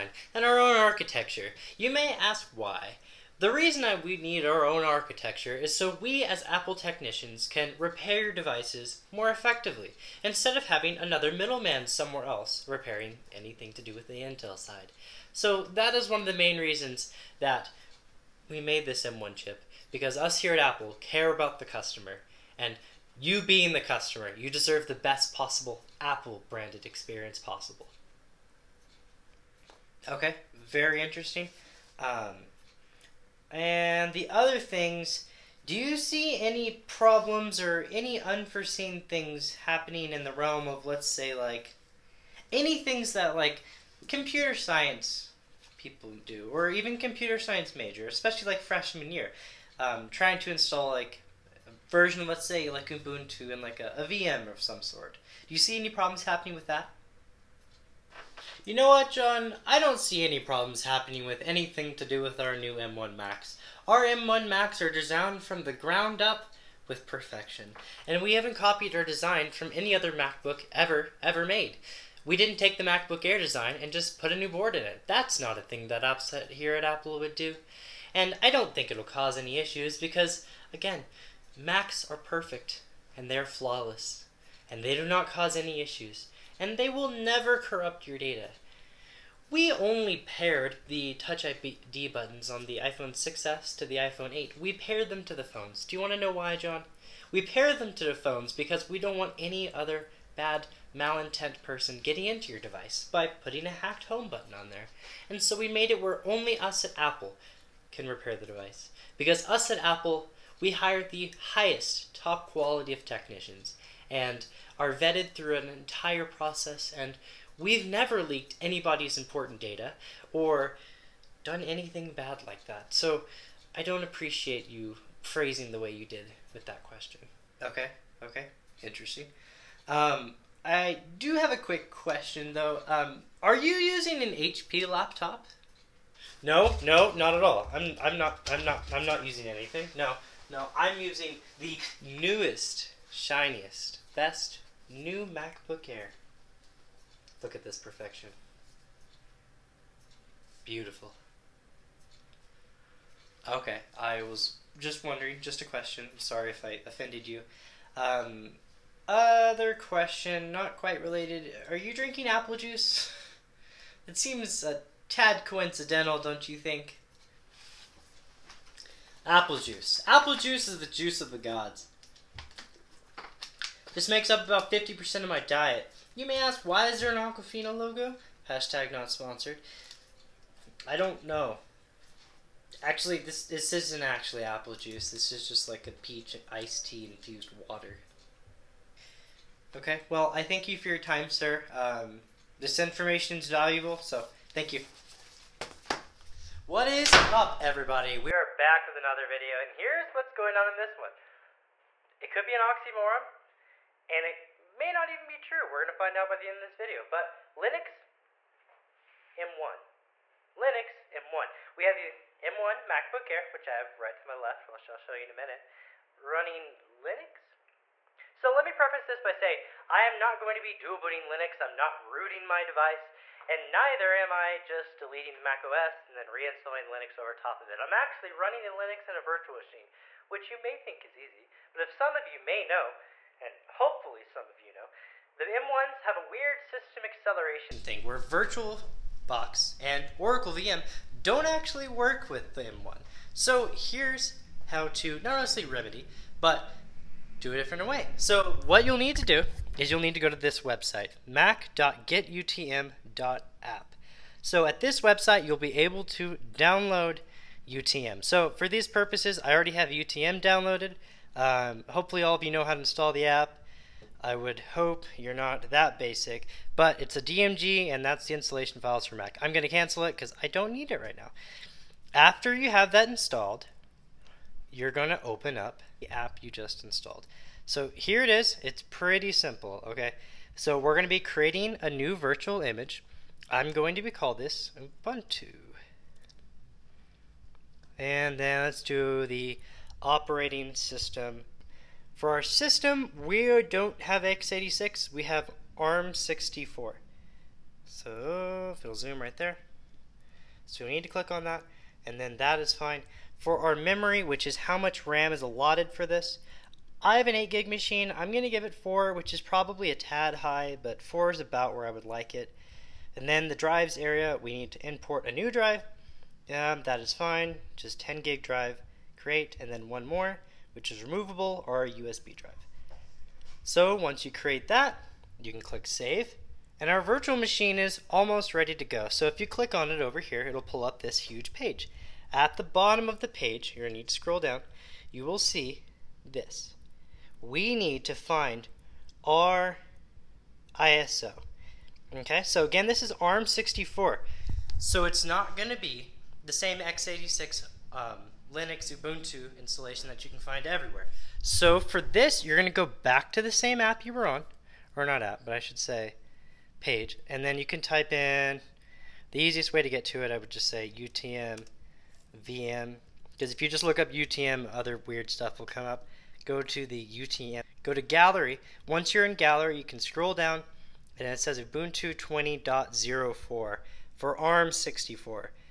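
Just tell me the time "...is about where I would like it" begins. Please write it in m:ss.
5:11.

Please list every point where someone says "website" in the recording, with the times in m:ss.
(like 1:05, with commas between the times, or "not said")
4:10, 4:15.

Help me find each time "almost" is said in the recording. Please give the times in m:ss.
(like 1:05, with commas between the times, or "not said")
5:28.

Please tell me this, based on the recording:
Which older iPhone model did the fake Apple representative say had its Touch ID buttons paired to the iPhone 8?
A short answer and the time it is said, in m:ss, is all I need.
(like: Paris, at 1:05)
iPhone 6s, at 1:32.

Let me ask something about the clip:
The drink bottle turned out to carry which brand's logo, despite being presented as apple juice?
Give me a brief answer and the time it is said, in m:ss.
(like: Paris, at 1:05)
Aquafina, at 2:57.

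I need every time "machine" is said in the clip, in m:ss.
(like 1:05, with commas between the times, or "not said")
3:49, 5:07, 5:27.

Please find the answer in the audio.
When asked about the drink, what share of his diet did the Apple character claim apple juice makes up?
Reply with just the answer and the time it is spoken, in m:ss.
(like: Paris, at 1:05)
50%, at 2:54.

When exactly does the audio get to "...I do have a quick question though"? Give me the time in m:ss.
2:10.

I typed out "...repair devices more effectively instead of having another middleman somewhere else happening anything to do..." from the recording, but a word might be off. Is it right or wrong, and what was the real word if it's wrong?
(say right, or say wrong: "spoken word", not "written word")
wrong: "repairing", not "happening".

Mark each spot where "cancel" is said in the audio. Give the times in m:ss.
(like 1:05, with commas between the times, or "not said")
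4:29.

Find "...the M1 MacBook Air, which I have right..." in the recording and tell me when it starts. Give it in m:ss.
3:31.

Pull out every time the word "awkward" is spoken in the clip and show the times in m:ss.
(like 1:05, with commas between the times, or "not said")
not said.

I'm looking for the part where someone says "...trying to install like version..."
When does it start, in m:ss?
0:50.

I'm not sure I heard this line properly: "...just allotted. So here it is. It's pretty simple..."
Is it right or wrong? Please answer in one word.
wrong.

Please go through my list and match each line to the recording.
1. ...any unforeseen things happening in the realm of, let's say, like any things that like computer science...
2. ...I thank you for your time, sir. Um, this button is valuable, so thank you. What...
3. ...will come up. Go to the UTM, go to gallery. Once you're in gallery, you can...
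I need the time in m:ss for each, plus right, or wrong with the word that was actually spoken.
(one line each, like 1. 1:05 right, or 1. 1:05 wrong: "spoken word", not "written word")
1. 0:37 right
2. 3:10 wrong: "information", not "button"
3. 6:05 right.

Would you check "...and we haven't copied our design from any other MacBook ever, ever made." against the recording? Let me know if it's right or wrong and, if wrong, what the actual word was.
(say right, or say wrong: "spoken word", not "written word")
right.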